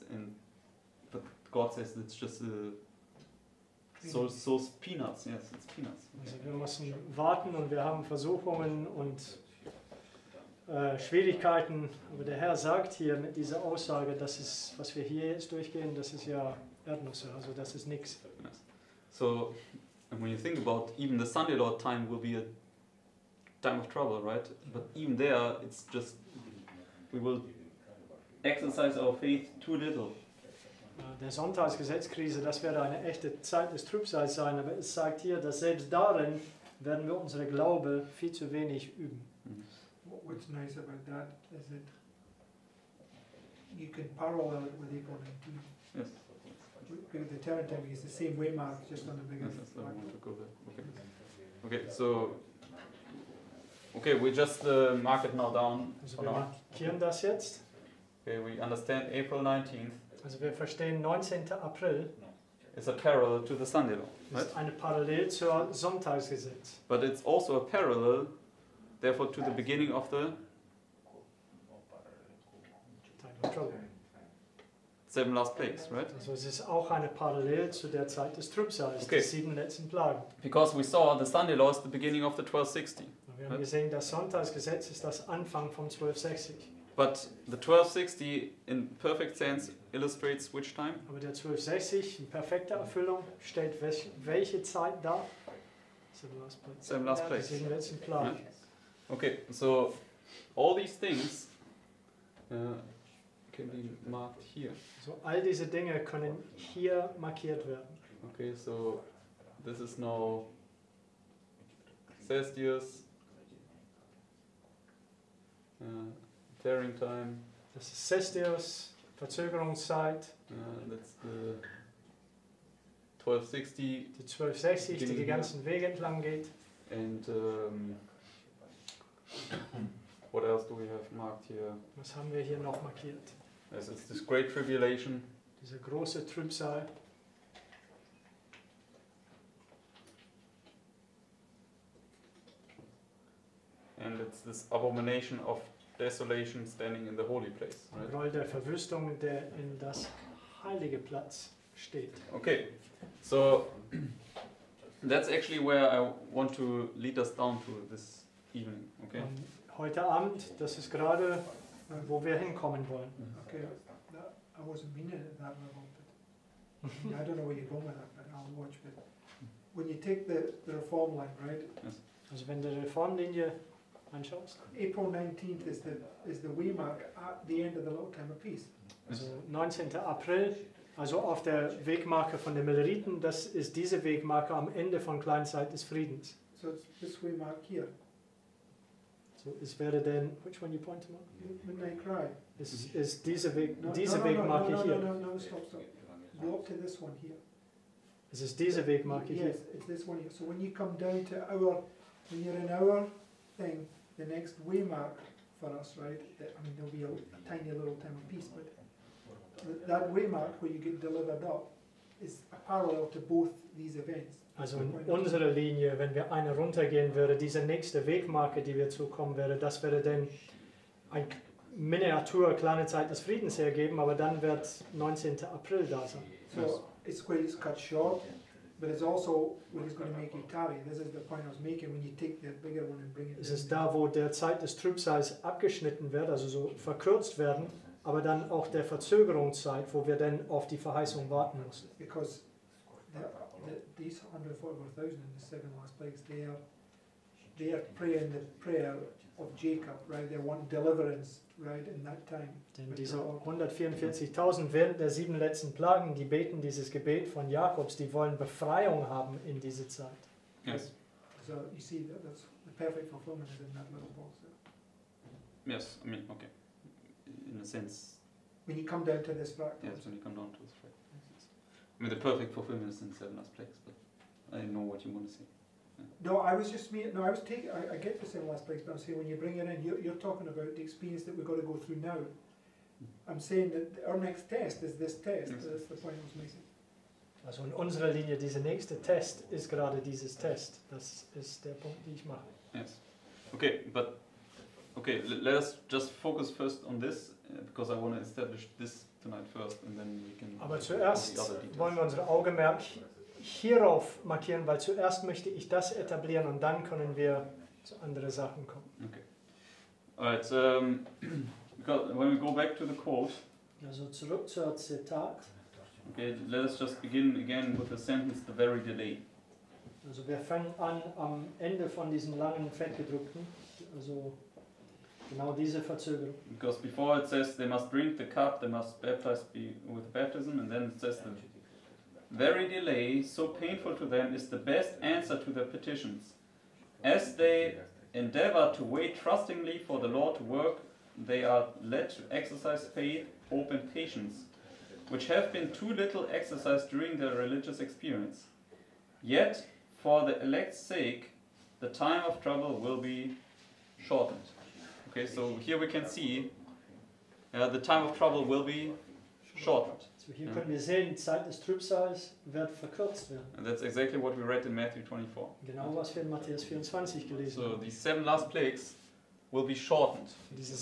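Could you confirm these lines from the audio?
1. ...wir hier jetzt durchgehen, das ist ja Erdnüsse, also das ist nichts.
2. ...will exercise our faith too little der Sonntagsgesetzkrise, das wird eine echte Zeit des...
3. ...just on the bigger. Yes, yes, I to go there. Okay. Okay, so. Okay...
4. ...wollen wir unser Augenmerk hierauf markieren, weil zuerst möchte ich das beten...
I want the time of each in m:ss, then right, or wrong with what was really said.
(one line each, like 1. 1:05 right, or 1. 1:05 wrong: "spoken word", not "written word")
1. 0:14 right
2. 0:27 right
3. 0:48 right
4. 5:01 wrong: "etablieren", not "beten".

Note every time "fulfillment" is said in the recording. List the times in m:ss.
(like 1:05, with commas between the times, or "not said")
4:23, 4:32.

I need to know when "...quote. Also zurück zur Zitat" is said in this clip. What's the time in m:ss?
5:12.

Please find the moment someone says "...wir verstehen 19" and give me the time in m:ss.
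1:00.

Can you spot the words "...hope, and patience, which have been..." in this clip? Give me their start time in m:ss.
5:43.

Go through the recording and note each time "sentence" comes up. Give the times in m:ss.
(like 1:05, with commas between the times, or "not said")
5:17.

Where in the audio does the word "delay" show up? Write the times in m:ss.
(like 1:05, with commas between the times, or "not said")
5:18, 5:32.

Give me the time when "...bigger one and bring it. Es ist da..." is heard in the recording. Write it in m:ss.
3:52.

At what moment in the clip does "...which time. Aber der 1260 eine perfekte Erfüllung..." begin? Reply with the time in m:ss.
1:30.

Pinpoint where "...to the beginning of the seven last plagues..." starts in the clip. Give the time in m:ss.
1:09.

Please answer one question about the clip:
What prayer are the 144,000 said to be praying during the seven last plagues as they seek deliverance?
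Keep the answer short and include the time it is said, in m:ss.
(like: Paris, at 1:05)
the prayer of Jacob, at 4:08.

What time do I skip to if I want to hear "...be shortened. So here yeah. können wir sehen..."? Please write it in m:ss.
5:58.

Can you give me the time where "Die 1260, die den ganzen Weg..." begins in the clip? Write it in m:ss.
2:04.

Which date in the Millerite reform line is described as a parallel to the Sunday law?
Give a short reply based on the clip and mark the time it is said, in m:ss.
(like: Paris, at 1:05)
April 19, at 0:44.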